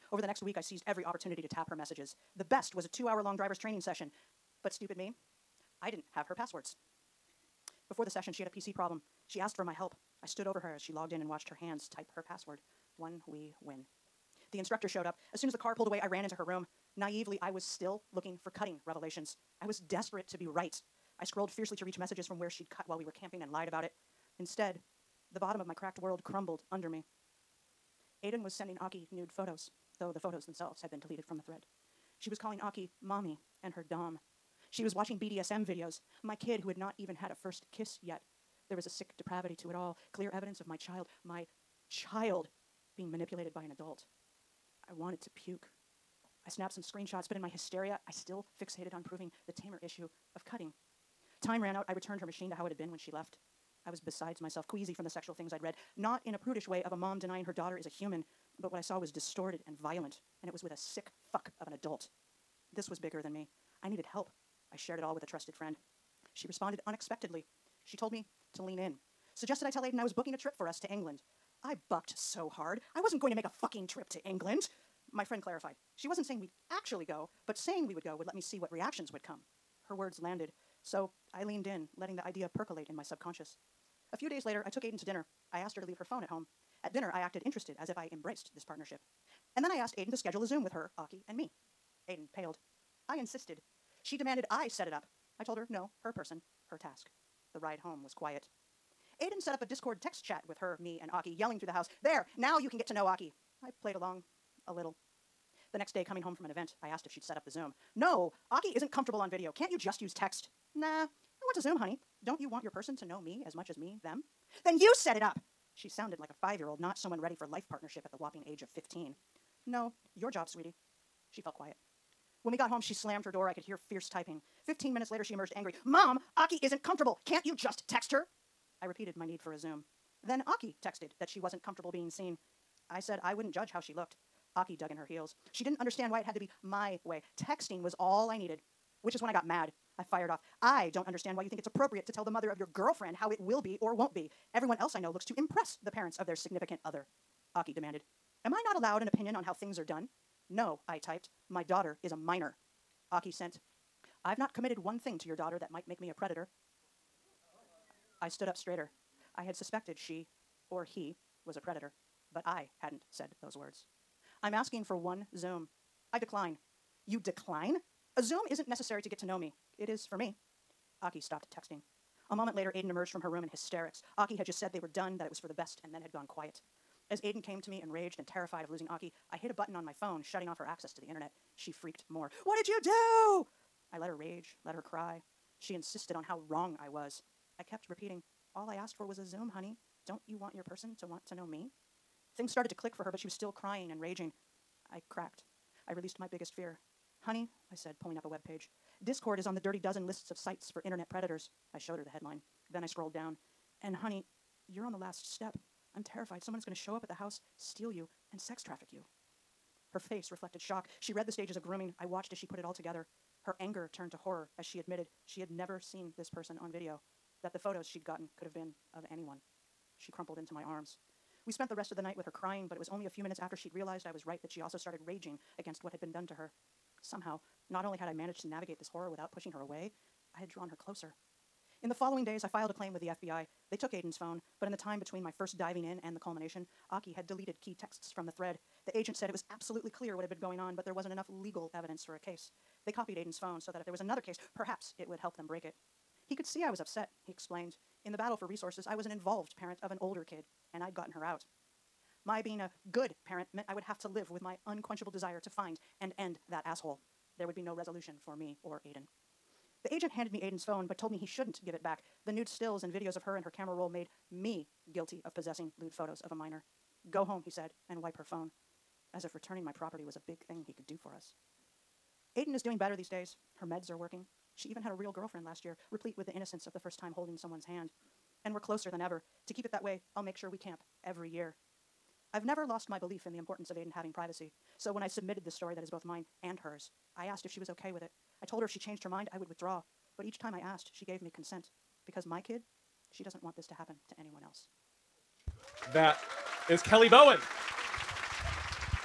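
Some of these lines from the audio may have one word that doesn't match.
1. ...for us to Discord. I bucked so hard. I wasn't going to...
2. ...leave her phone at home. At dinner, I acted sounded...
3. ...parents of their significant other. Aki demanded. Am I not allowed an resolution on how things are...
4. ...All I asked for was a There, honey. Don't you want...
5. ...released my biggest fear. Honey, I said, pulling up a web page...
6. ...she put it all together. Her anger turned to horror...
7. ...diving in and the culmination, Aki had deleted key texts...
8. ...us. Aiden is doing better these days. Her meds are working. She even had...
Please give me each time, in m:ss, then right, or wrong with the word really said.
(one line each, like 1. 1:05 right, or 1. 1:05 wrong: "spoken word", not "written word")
1. 1:10 wrong: "England", not "Discord"
2. 1:25 wrong: "interested", not "sounded"
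3. 2:25 wrong: "opinion", not "resolution"
4. 3:08 wrong: "Zoom", not "There"
5. 3:15 right
6. 3:32 right
7. 3:55 right
8. 4:31 right.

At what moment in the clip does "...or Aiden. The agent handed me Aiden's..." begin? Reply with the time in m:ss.
4:18.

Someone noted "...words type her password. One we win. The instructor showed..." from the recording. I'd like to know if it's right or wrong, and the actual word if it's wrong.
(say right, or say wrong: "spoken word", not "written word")
wrong: "hands", not "words".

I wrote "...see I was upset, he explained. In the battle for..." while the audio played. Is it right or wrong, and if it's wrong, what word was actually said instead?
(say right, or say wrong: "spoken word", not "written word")
right.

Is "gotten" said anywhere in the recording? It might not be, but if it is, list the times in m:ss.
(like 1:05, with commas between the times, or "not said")
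3:38, 4:10.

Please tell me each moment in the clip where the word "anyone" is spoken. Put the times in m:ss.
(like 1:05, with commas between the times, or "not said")
3:39, 4:54.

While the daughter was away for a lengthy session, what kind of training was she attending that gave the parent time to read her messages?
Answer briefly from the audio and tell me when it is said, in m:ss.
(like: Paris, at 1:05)
Driver's training, at 0:03.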